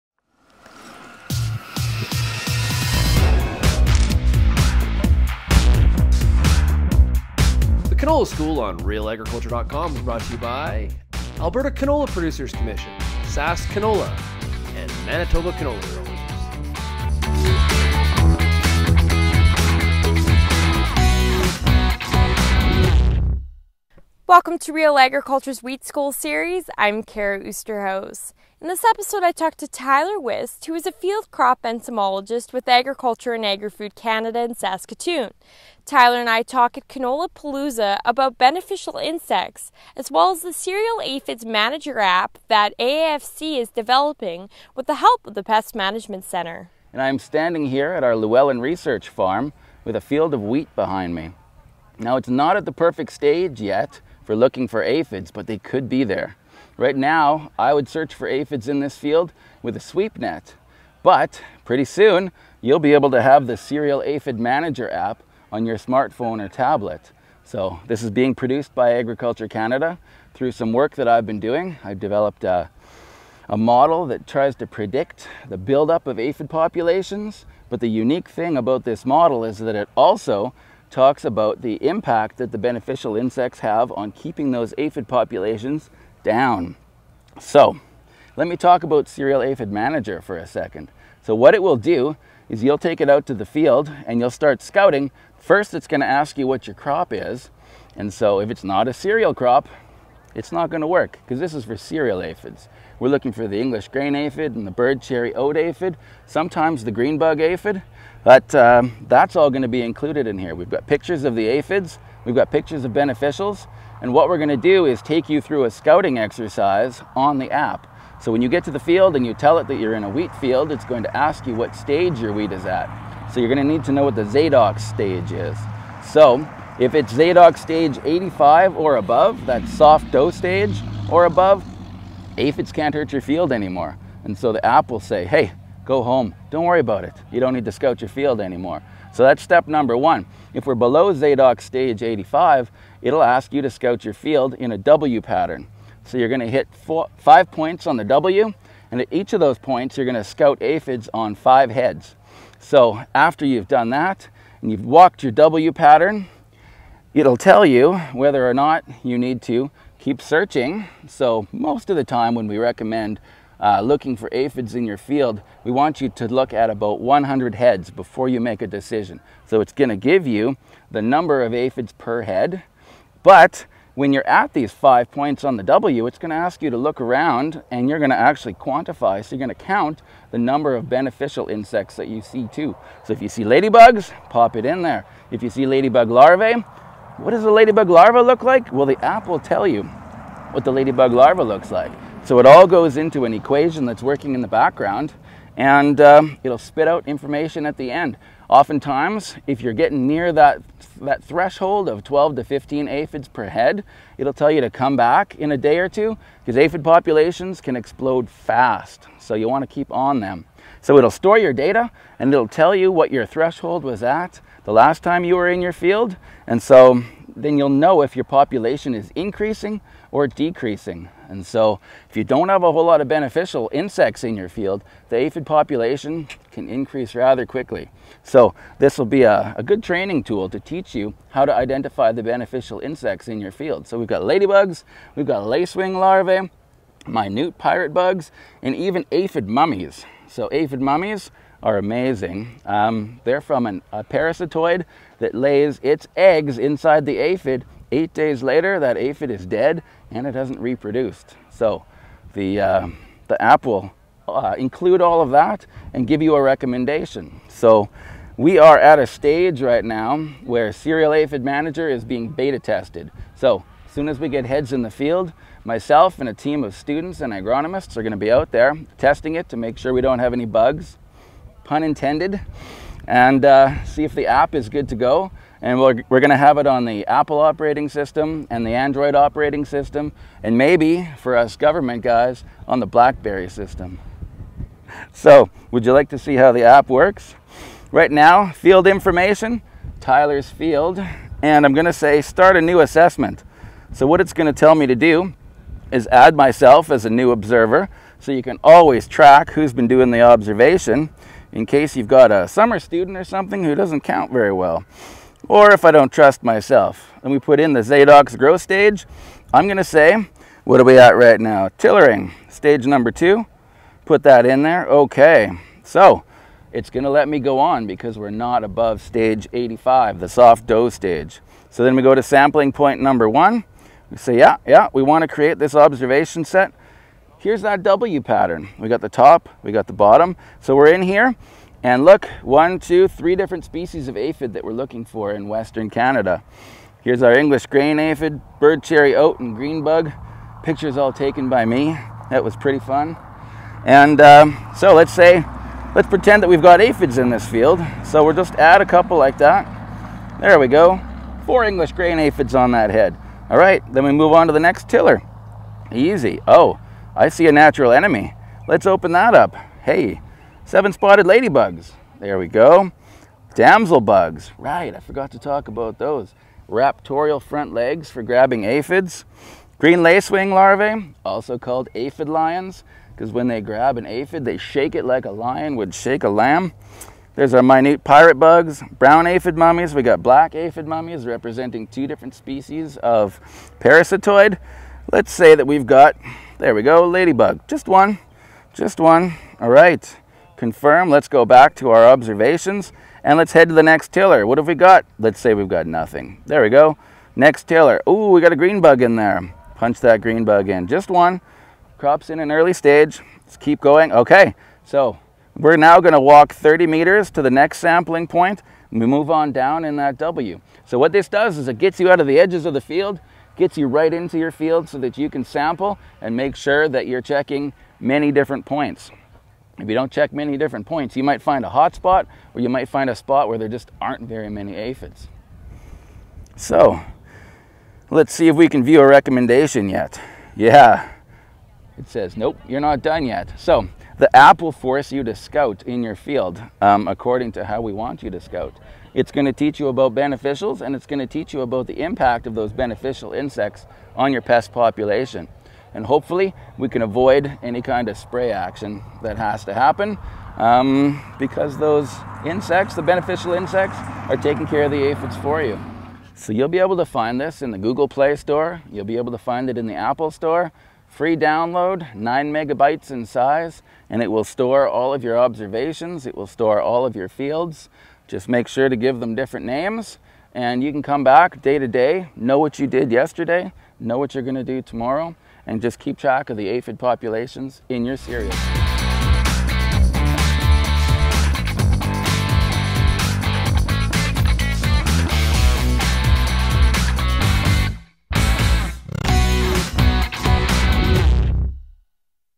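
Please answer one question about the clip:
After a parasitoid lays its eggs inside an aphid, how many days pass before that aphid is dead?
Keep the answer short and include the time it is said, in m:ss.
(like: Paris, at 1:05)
8, at 4:07.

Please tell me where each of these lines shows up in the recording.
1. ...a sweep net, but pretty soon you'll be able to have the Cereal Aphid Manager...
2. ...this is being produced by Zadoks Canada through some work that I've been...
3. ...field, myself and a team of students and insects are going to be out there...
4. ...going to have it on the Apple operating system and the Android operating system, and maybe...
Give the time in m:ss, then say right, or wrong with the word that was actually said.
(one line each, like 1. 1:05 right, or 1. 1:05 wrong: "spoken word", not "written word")
1. 0:59 right
2. 1:07 wrong: "Agriculture", not "Zadoks"
3. 4:24 wrong: "agronomists", not "insects"
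4. 4:36 right.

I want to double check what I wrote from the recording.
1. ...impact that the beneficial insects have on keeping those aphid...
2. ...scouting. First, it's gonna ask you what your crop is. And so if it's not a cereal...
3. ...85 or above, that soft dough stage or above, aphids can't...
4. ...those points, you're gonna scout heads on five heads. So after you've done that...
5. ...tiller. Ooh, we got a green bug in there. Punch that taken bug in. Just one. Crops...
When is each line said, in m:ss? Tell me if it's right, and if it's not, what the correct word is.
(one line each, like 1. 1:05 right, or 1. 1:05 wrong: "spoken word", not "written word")
1. 1:21 right
2. 1:34 right
3. 2:08 right
4. 2:29 wrong: "aphids", not "heads"
5. 6:37 wrong: "green", not "taken".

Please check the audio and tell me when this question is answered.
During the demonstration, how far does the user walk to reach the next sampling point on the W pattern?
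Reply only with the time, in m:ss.
6:46.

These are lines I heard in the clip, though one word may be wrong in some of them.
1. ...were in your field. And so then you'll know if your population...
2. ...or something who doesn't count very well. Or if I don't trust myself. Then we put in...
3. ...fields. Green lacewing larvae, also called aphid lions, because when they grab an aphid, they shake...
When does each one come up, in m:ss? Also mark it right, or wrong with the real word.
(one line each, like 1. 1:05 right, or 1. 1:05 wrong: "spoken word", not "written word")
1. 3:35 right
2. 5:03 right
3. 6:08 wrong: "aphids", not "fields".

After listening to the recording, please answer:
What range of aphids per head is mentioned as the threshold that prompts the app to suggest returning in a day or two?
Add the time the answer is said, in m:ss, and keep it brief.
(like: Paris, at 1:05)
12 to 15, at 3:22.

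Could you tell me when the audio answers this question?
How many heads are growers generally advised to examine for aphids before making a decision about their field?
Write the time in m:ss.
2:46.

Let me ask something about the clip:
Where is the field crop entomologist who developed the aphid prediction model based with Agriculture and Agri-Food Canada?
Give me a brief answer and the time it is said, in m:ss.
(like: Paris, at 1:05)
Saskatoon, at 0:34.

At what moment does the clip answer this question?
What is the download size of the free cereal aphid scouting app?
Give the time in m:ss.
7:42.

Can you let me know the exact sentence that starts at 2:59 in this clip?
So you're going to count the number of beneficial insects that you see too.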